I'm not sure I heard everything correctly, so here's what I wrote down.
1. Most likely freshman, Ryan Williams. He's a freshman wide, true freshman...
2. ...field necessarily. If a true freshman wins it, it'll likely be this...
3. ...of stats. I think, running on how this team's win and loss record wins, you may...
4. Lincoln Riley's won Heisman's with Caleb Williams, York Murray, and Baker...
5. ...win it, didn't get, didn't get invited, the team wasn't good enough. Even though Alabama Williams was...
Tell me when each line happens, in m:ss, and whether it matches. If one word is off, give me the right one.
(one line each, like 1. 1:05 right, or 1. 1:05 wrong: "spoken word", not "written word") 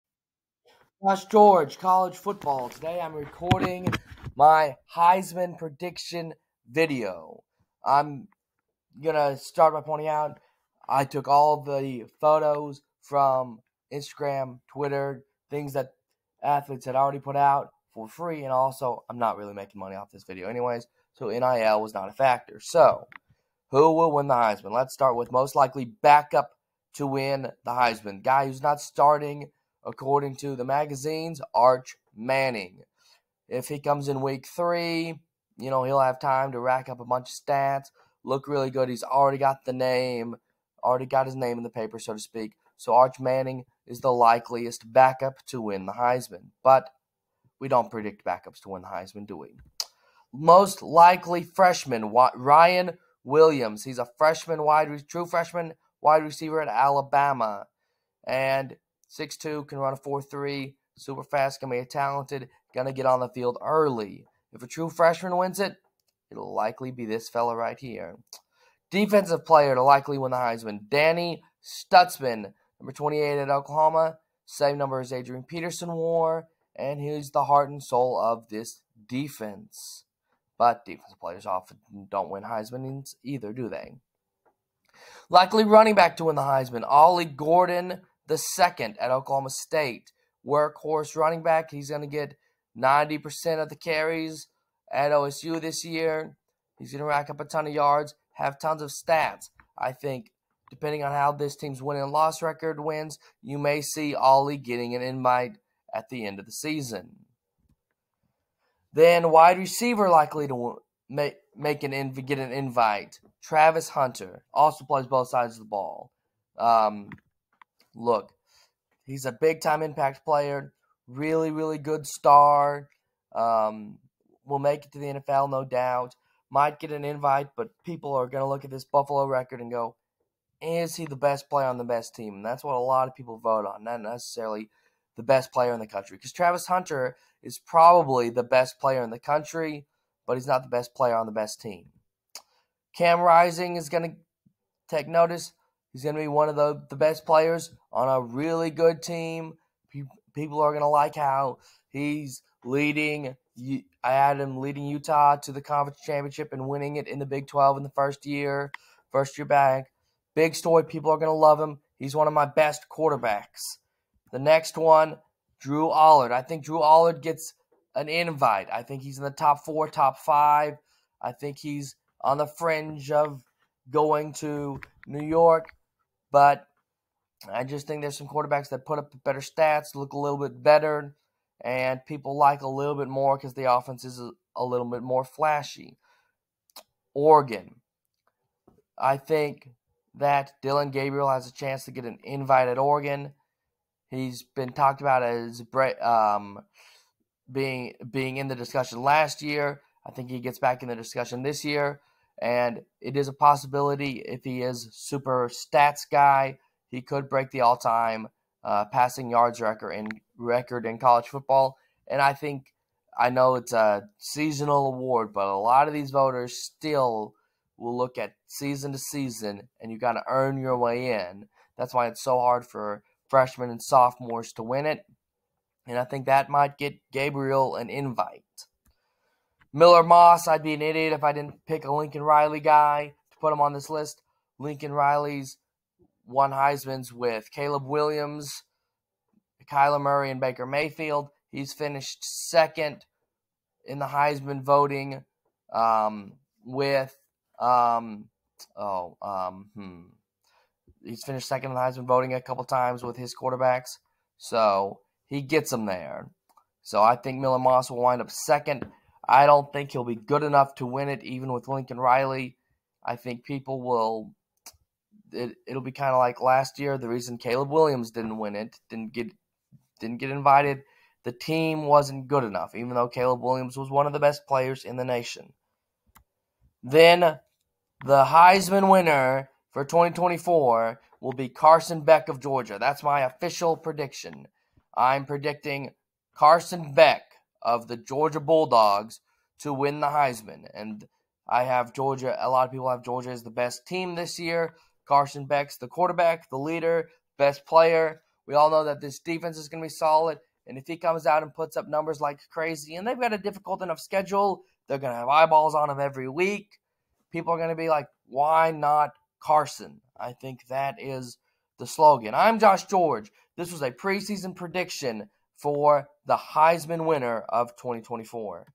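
1. 0:50 right
2. 1:03 wrong: "early", not "necessarily"
3. 1:38 wrong: "depending", not "running"
4. 3:54 wrong: "Kyler", not "York"
5. 4:28 wrong: "Caleb", not "Alabama".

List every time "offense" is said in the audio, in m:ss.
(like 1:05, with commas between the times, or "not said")
3:03.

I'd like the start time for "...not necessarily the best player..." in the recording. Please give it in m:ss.
2:13.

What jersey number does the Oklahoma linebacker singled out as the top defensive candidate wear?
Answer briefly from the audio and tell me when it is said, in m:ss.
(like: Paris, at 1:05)
28, at 1:12.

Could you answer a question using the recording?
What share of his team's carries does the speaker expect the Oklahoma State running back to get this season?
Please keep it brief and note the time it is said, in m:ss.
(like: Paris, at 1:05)
90%, at 1:32.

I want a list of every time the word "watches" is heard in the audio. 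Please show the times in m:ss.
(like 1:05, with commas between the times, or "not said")
not said.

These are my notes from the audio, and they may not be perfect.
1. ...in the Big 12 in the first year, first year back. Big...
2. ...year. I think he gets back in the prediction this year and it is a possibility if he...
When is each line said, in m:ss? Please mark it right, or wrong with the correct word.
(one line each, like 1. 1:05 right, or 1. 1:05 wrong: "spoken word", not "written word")
1. 2:37 right
2. 3:19 wrong: "discussion", not "prediction".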